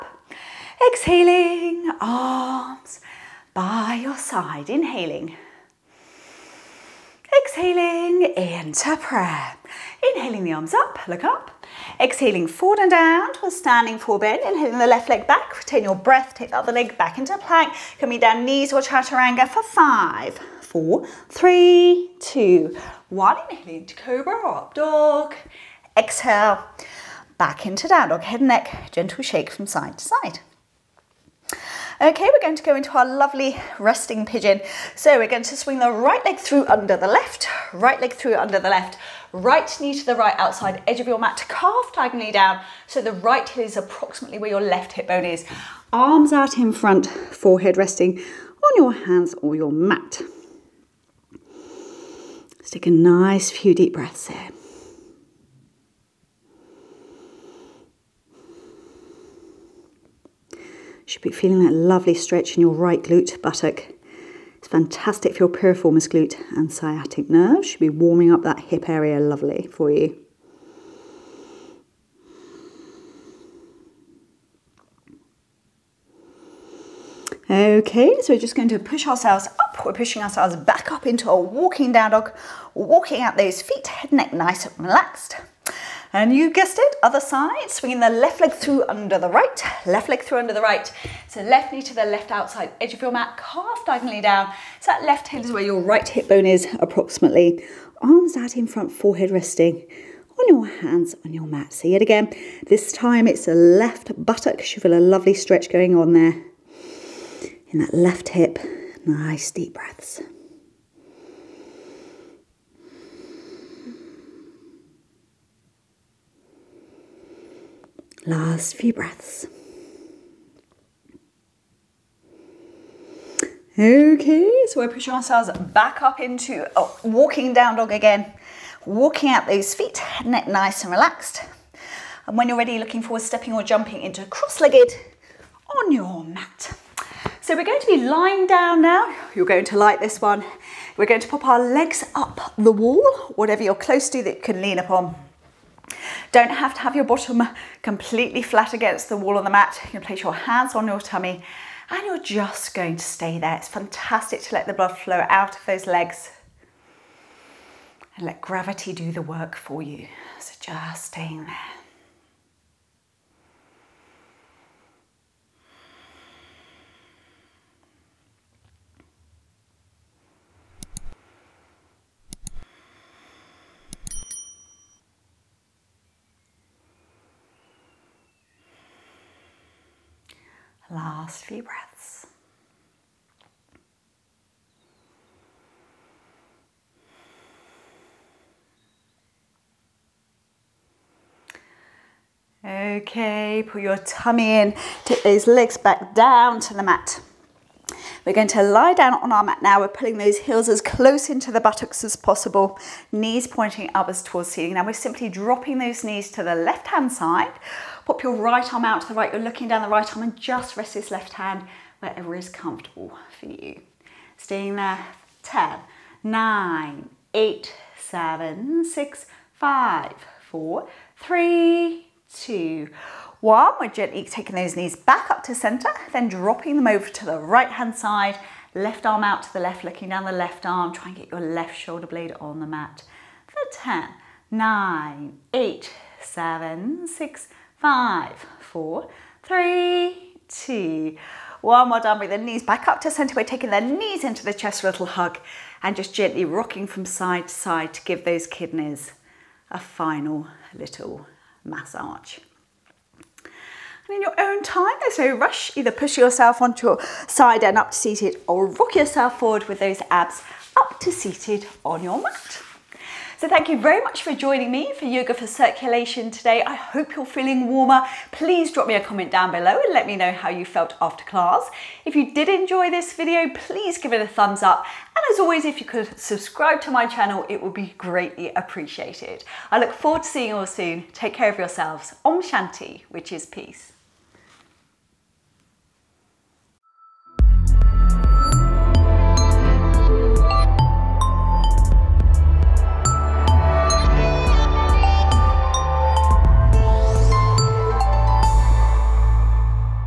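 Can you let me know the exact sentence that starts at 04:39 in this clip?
I look forward to seeing you all soon.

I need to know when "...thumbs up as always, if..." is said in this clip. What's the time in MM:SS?
04:34.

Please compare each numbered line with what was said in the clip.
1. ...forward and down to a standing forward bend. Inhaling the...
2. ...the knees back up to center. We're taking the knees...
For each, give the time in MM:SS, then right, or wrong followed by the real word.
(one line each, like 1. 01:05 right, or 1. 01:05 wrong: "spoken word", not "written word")
1. 00:12 right
2. 04:02 right.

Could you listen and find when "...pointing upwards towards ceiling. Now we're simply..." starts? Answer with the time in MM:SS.
03:23.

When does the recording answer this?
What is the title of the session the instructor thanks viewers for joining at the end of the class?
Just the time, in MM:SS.
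04:25.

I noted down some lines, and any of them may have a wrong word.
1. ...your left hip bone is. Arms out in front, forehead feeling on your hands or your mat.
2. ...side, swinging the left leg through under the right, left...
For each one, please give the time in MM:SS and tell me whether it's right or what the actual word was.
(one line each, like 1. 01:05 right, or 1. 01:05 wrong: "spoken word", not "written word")
1. 00:44 wrong: "resting", not "feeling"
2. 01:27 right.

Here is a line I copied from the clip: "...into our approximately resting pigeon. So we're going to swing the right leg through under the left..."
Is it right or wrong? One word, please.
wrong.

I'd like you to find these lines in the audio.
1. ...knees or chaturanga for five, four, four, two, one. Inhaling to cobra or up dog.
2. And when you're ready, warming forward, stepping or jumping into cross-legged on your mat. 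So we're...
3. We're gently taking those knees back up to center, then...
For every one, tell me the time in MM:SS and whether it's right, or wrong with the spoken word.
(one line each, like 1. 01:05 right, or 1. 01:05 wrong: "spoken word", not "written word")
1. 00:18 wrong: "three", not "four"
2. 02:12 wrong: "looking", not "warming"
3. 03:43 right.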